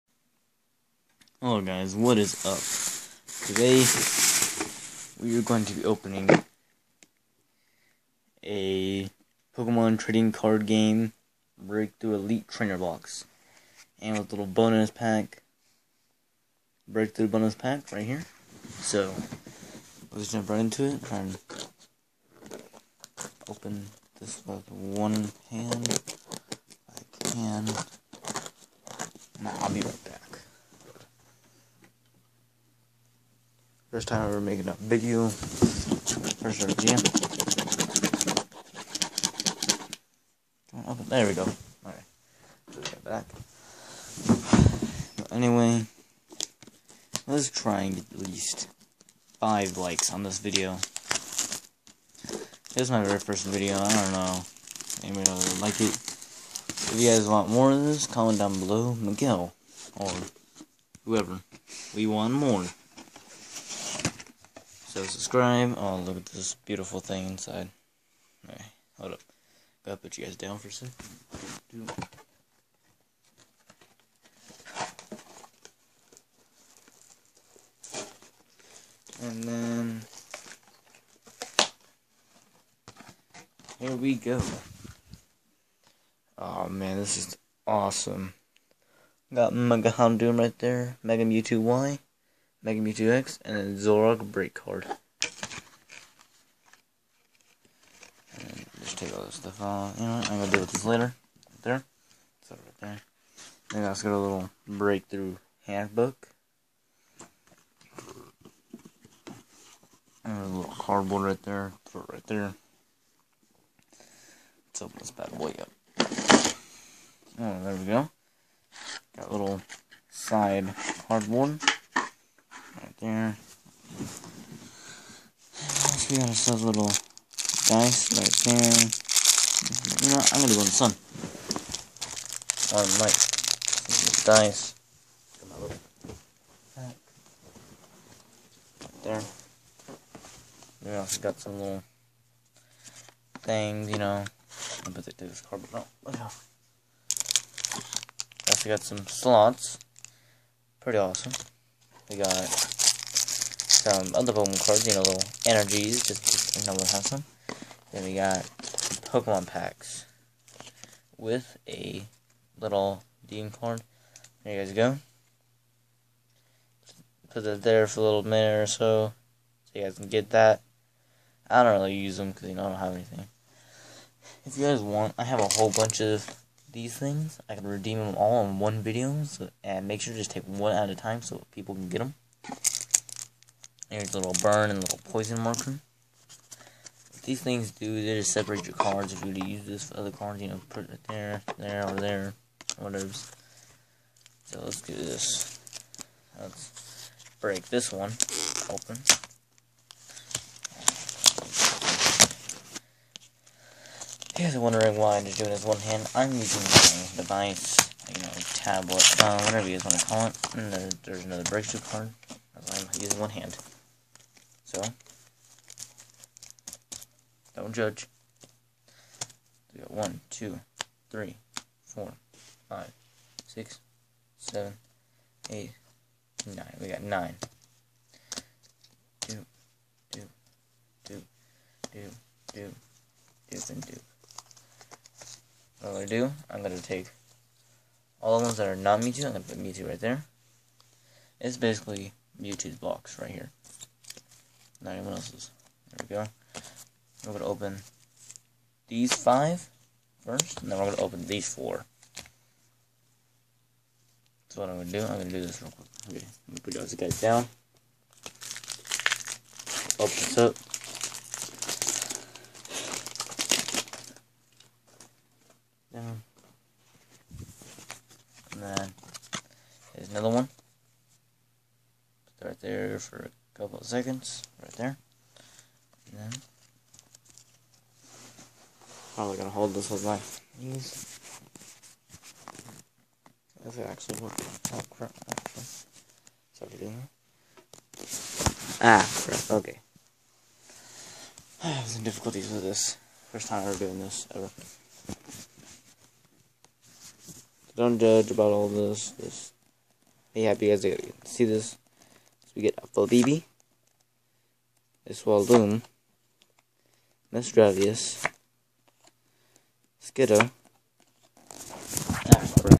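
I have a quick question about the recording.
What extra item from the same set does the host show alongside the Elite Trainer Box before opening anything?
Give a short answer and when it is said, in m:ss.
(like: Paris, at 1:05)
Breakthrough bonus pack, at 0:16.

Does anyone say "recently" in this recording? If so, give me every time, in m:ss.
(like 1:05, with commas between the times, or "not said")
not said.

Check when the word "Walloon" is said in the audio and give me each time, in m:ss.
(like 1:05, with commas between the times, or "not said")
5:05.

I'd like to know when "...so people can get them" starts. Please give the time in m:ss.
3:01.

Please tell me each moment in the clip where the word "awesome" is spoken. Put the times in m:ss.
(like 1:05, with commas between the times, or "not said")
1:27, 2:30.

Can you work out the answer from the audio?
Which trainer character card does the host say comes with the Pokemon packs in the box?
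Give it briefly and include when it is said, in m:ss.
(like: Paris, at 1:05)
Dean, at 2:43.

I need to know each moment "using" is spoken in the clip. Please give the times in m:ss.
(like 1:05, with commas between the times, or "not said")
3:26, 3:32.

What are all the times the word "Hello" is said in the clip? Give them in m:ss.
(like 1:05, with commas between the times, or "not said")
0:01.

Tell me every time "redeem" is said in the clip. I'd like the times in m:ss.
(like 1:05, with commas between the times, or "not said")
2:57.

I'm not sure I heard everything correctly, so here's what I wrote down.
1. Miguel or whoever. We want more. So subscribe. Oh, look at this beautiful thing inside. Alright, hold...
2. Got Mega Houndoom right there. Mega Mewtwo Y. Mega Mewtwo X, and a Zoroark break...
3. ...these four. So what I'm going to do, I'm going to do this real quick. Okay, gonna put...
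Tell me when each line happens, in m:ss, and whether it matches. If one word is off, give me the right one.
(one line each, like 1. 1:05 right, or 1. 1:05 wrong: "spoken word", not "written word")
1. 0:58 right
2. 1:29 right
3. 4:11 right.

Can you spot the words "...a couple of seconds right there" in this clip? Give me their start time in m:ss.
4:33.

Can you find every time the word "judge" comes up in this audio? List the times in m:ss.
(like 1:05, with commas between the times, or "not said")
3:37, 4:57.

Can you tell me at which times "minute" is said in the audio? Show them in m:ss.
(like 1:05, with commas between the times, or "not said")
2:48.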